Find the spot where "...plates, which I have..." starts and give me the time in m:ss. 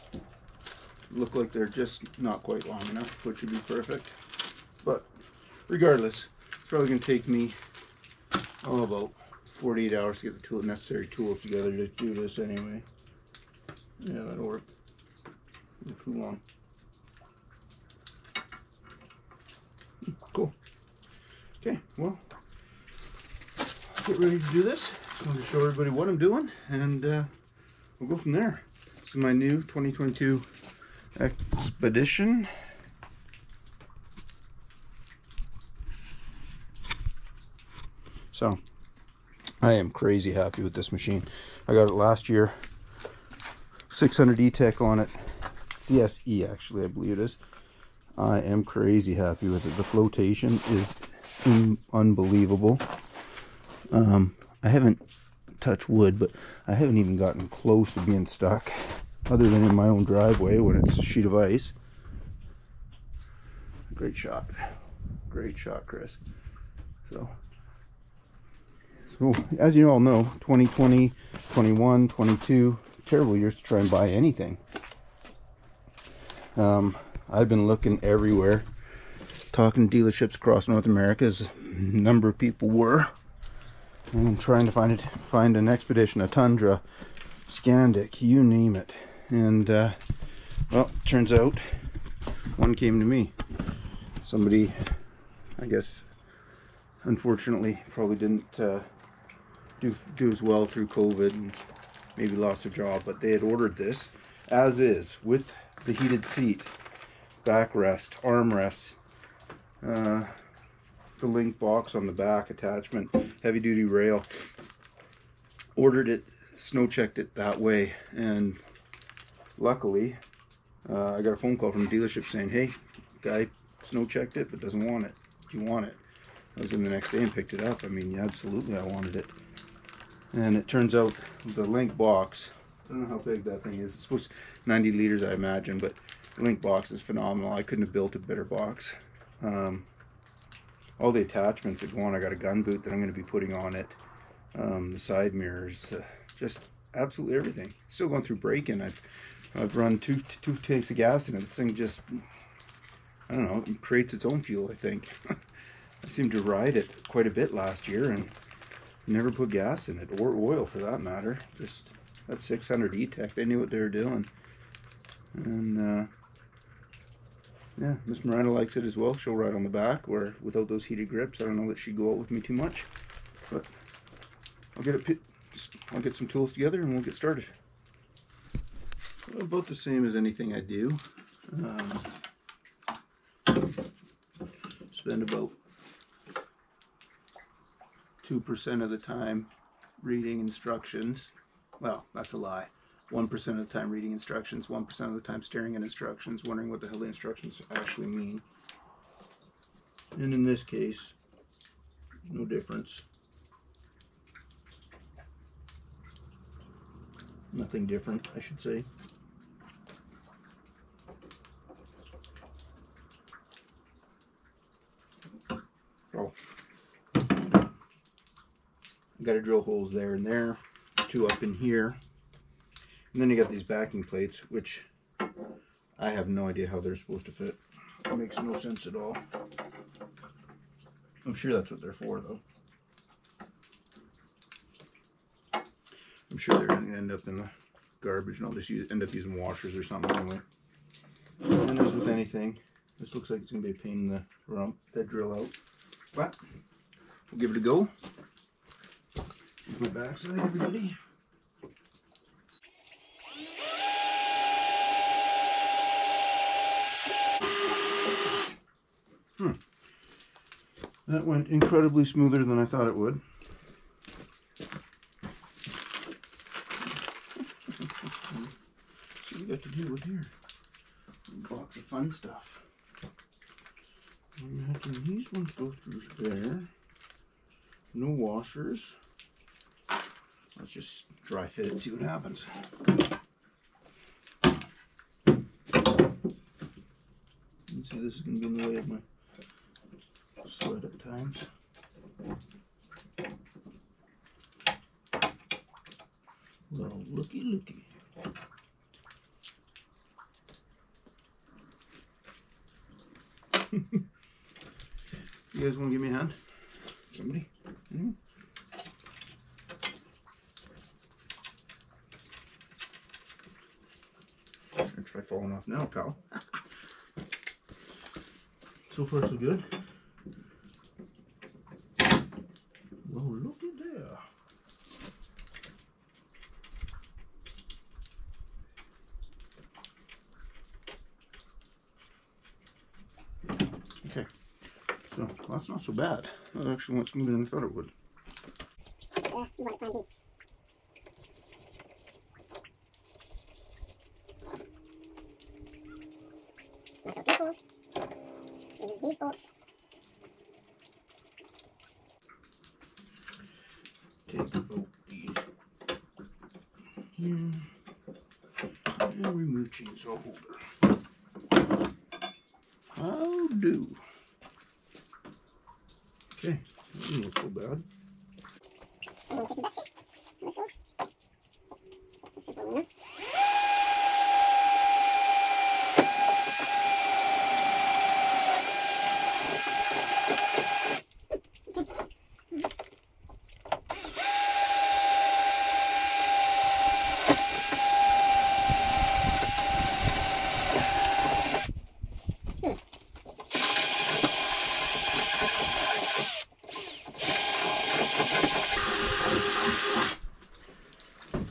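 3:44.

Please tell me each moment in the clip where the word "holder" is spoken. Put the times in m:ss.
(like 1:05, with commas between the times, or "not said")
6:00.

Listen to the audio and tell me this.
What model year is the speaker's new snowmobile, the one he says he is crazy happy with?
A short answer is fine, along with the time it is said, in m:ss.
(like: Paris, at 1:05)
2022, at 0:29.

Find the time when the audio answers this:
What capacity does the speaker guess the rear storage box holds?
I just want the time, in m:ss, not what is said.
2:14.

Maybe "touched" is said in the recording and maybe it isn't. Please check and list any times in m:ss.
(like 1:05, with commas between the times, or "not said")
0:55.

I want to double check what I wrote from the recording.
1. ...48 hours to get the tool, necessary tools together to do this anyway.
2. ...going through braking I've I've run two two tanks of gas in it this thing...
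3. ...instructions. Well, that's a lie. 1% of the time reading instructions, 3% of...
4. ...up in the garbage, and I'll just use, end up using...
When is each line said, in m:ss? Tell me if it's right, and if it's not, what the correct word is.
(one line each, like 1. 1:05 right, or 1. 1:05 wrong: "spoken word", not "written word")
1. 0:09 right
2. 2:28 right
3. 3:10 wrong: "1", not "3"
4. 3:57 right.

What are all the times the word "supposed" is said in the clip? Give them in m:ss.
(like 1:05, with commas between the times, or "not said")
2:14, 3:46.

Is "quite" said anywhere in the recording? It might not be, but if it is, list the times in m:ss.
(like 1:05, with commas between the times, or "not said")
0:02, 2:37.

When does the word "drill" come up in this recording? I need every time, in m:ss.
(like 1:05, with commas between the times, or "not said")
3:39, 4:05.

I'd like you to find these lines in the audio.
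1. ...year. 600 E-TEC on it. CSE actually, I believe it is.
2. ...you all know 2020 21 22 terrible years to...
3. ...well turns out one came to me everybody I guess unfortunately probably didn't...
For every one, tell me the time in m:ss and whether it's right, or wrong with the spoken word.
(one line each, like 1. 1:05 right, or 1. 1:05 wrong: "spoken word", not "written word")
1. 0:42 right
2. 1:09 right
3. 1:30 wrong: "somebody", not "everybody".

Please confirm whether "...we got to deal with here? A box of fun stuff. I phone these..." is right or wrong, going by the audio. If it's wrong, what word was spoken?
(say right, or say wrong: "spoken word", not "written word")
wrong: "imagine", not "phone".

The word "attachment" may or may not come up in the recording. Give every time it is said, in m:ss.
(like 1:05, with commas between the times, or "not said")
1:52, 2:21.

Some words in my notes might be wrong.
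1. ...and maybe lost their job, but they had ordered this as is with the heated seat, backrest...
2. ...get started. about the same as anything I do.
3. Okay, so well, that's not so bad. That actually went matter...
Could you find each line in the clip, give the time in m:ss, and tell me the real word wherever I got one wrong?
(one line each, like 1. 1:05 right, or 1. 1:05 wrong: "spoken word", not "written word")
1. 1:41 right
2. 2:57 right
3. 5:34 wrong: "smoother", not "matter".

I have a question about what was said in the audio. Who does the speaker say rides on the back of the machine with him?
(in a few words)
Miranda.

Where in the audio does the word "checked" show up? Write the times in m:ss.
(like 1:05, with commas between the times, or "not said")
1:56, 2:04.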